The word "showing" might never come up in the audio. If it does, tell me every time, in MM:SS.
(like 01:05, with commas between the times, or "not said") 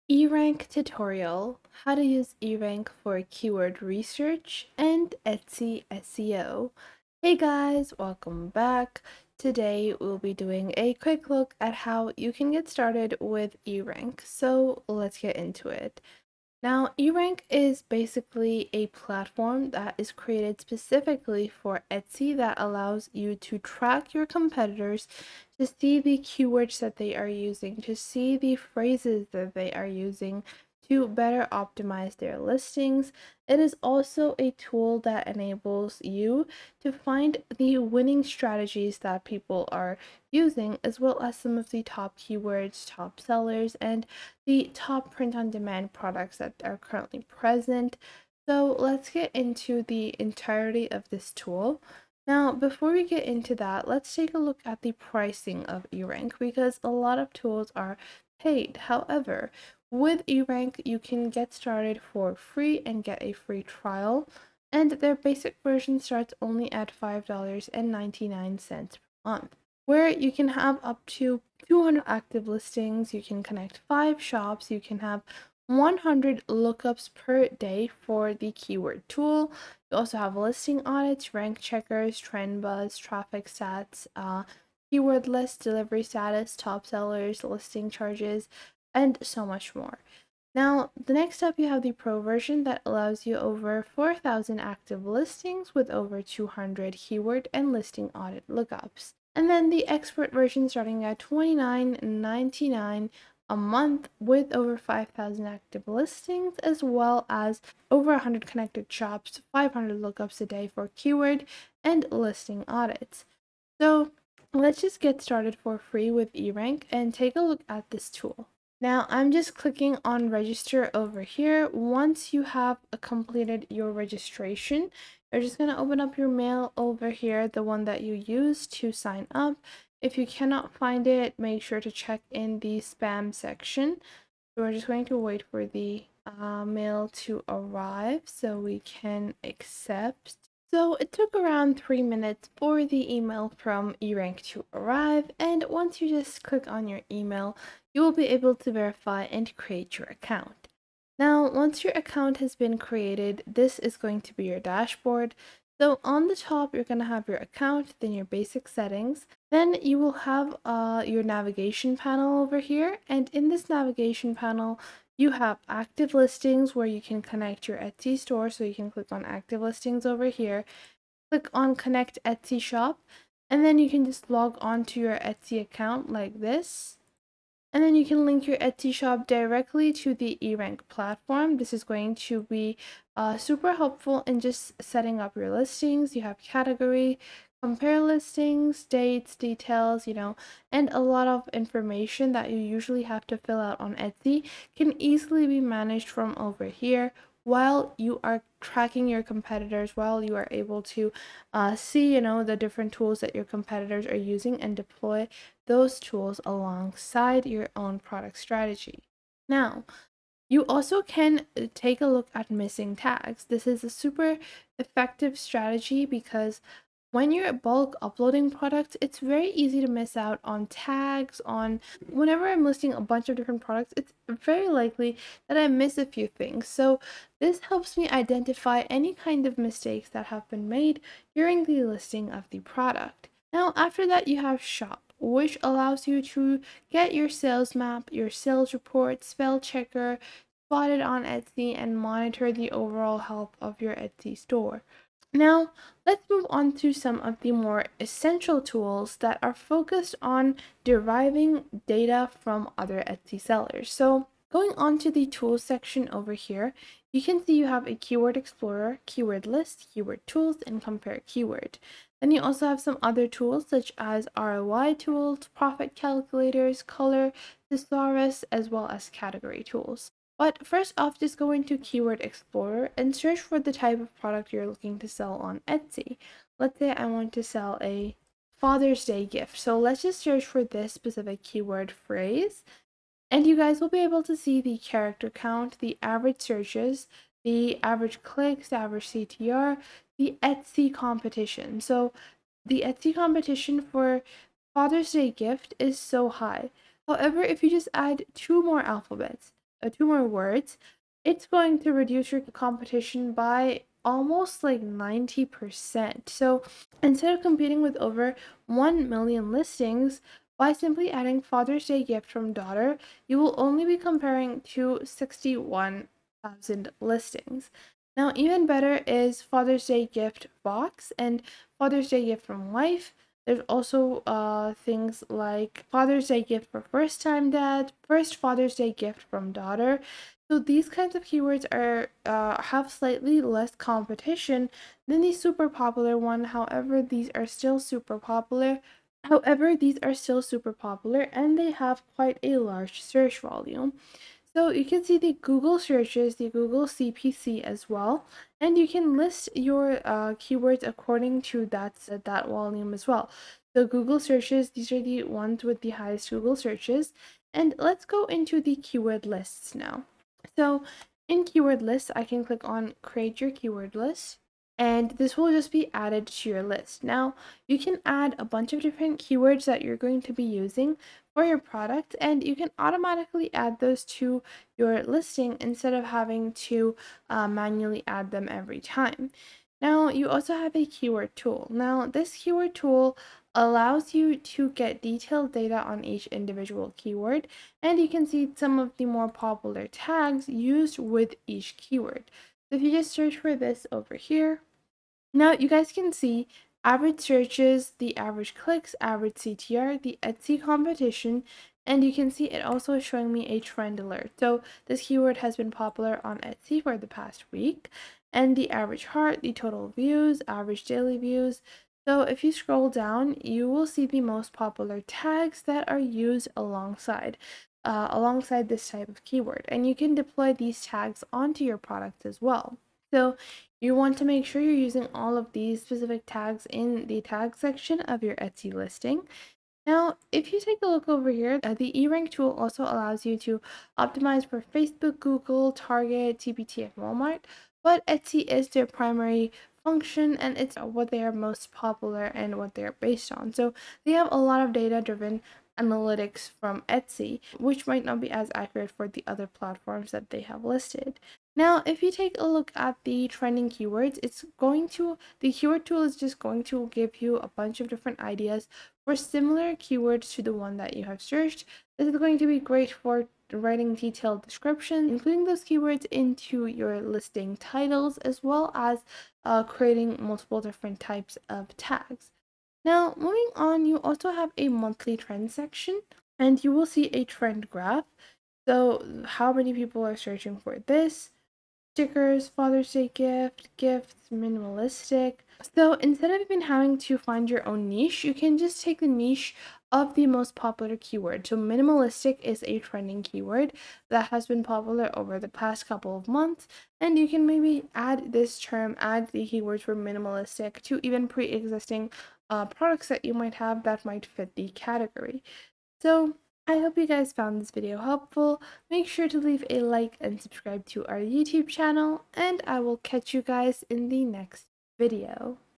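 06:43.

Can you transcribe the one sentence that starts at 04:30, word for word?
But first off, just go into Keyword Explorer and search for the type of product you're looking to sell on Etsy.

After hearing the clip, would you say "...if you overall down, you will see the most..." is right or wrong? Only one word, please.
wrong.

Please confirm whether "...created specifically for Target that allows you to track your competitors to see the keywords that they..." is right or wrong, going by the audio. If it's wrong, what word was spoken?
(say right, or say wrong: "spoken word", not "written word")
wrong: "Etsy", not "Target".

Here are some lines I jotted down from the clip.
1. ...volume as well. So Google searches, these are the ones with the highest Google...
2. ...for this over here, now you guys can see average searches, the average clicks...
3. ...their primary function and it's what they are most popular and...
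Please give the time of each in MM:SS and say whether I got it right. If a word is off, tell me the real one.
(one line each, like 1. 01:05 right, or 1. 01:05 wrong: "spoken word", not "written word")
1. 05:52 right
2. 06:33 right
3. 07:18 right.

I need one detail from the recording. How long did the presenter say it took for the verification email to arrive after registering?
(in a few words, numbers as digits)
3 minutes.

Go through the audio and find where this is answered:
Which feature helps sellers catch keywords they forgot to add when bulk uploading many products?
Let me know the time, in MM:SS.
03:32.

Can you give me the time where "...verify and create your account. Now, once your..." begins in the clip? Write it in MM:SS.
02:28.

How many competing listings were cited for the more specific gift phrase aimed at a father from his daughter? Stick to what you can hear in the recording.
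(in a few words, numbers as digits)
61,000.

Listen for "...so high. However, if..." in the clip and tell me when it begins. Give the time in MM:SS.
04:55.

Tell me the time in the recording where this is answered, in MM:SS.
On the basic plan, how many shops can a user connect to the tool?
01:13.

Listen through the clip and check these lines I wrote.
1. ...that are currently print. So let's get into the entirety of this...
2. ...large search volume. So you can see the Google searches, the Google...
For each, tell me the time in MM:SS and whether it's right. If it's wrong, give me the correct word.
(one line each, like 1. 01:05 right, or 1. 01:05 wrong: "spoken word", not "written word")
1. 00:46 wrong: "present", not "print"
2. 05:42 right.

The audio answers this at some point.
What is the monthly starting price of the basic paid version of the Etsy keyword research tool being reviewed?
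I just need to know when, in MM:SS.
01:06.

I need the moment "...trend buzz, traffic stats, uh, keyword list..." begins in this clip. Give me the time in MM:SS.
01:22.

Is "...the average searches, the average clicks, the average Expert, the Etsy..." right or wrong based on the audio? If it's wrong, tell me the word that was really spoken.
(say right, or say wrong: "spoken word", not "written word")
wrong: "CTR", not "Expert".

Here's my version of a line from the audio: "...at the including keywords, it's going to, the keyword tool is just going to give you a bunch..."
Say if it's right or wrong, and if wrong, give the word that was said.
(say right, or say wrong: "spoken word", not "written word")
wrong: "trending", not "including".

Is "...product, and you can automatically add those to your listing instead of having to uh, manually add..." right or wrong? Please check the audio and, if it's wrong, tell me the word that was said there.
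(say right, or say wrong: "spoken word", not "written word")
right.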